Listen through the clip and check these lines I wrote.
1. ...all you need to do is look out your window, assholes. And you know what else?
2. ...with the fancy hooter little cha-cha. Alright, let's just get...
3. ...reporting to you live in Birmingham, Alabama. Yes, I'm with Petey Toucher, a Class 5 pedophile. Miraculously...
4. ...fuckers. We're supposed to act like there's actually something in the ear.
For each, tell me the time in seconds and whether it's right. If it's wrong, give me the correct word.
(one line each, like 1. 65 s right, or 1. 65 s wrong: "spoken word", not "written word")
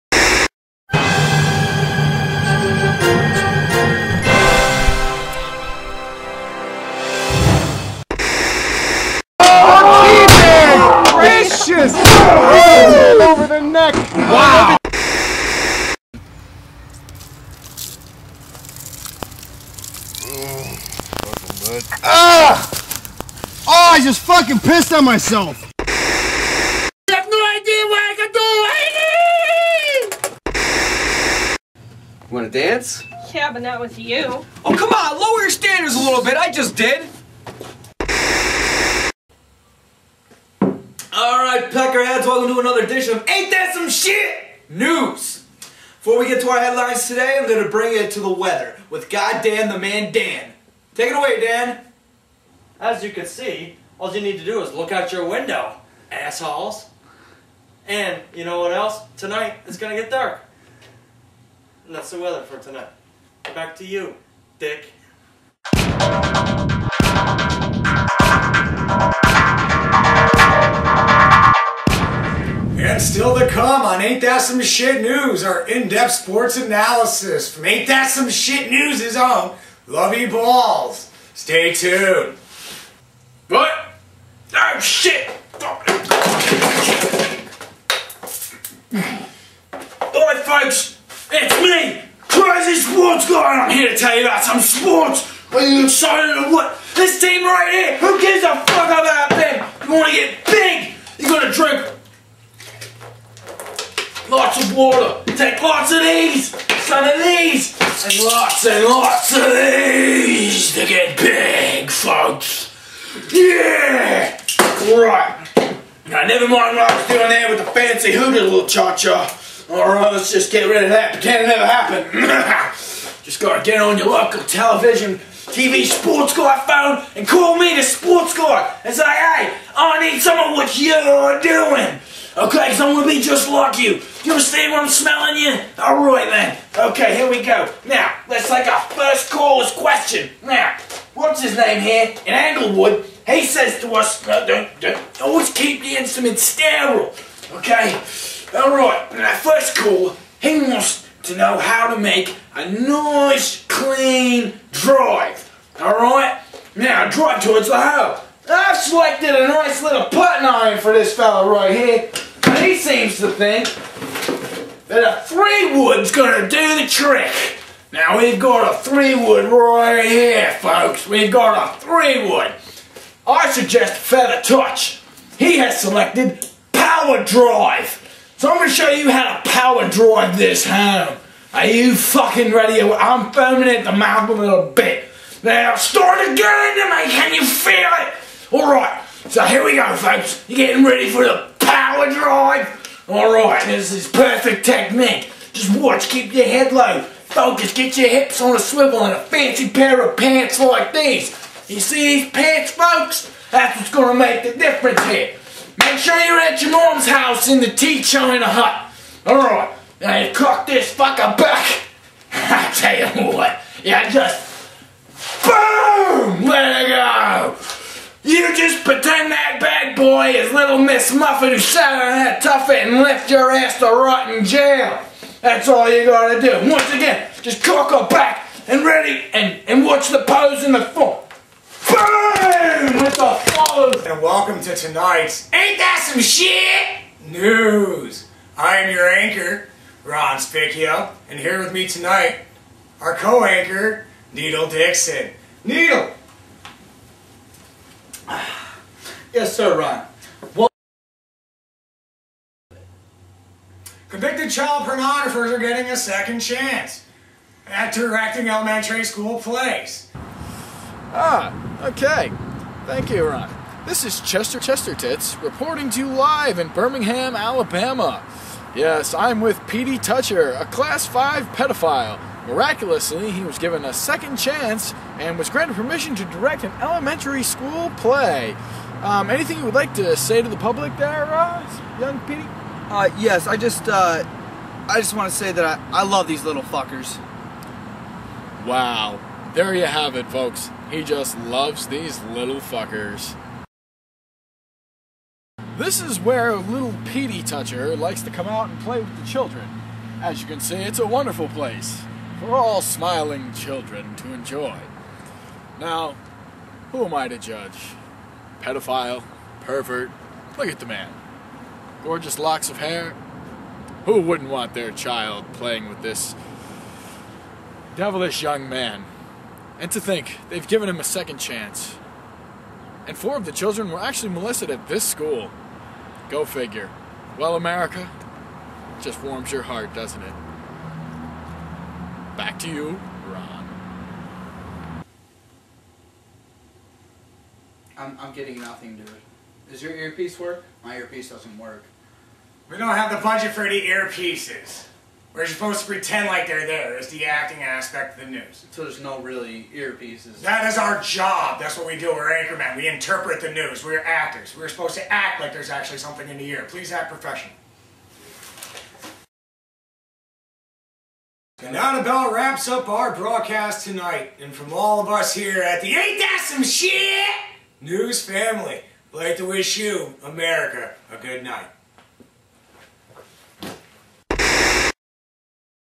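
1. 54 s right
2. 117 s right
3. 265 s right
4. 354 s wrong: "actors", not "fuckers".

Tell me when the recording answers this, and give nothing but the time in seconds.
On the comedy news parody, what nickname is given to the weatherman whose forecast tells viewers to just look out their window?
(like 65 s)
49 s.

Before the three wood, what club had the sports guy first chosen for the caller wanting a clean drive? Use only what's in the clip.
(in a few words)
putting iron.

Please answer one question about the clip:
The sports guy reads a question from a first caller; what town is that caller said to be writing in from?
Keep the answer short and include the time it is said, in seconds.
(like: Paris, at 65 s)
Anglewood, at 142 s.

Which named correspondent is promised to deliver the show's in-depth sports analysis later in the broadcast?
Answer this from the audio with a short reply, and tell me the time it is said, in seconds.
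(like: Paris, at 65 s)
Lovey Balls, at 79 s.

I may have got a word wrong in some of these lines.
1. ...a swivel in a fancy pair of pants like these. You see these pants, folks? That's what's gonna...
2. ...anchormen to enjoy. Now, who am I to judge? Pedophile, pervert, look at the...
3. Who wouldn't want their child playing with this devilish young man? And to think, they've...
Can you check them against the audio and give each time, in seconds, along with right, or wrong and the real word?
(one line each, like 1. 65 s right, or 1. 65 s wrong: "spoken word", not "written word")
1. 198 s right
2. 303 s wrong: "children", not "anchormen"
3. 314 s right.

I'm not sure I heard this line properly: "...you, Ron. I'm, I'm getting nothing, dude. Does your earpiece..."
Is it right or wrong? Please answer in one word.
right.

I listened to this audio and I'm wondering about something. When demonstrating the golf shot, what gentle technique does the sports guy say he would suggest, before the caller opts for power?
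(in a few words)
Feather Touch.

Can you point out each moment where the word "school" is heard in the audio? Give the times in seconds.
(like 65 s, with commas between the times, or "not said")
259 s, 277 s, 325 s.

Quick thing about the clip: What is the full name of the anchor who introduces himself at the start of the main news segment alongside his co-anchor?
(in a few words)
Ron Spicchio.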